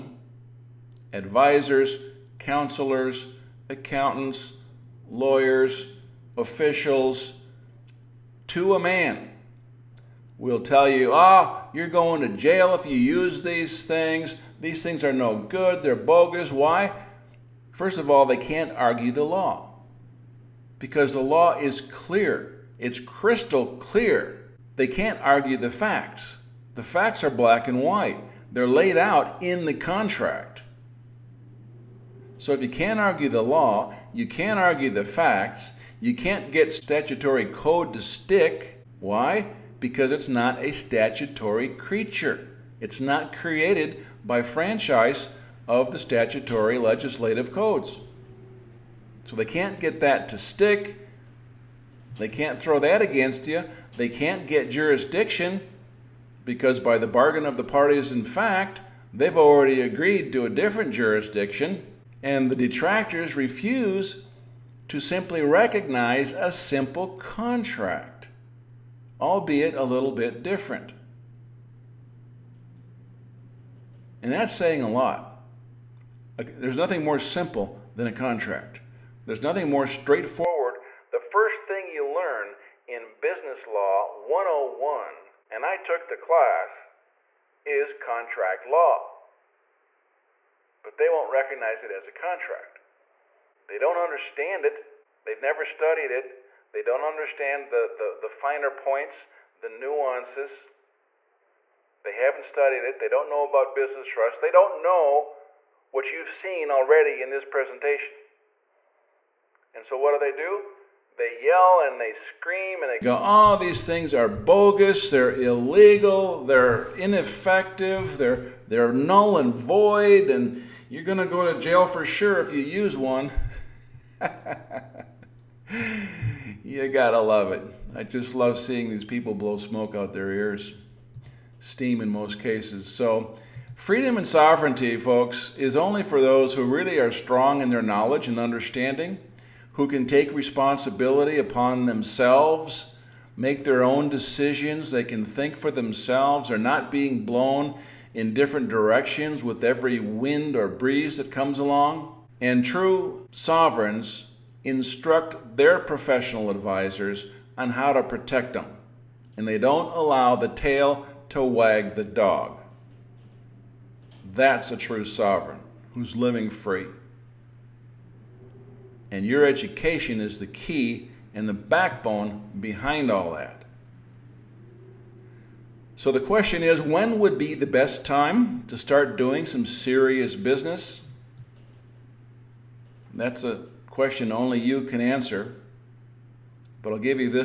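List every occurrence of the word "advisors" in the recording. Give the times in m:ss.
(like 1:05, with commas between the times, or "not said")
0:01, 2:36.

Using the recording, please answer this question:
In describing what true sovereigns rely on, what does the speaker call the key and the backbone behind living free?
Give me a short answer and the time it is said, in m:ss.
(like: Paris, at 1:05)
Education, at 2:49.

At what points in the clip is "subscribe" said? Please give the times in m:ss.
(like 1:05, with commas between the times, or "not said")
not said.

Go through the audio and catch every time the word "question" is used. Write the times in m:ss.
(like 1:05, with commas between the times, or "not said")
2:56, 3:03.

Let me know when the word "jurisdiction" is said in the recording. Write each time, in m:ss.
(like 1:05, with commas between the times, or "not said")
0:54, 1:00.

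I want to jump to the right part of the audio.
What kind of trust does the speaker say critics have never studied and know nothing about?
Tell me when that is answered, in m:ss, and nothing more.
1:43.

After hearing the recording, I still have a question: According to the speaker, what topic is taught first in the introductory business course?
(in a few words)
Contract law.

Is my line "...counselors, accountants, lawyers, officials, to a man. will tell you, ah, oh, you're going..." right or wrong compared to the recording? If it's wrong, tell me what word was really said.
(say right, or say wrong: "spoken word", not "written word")
right.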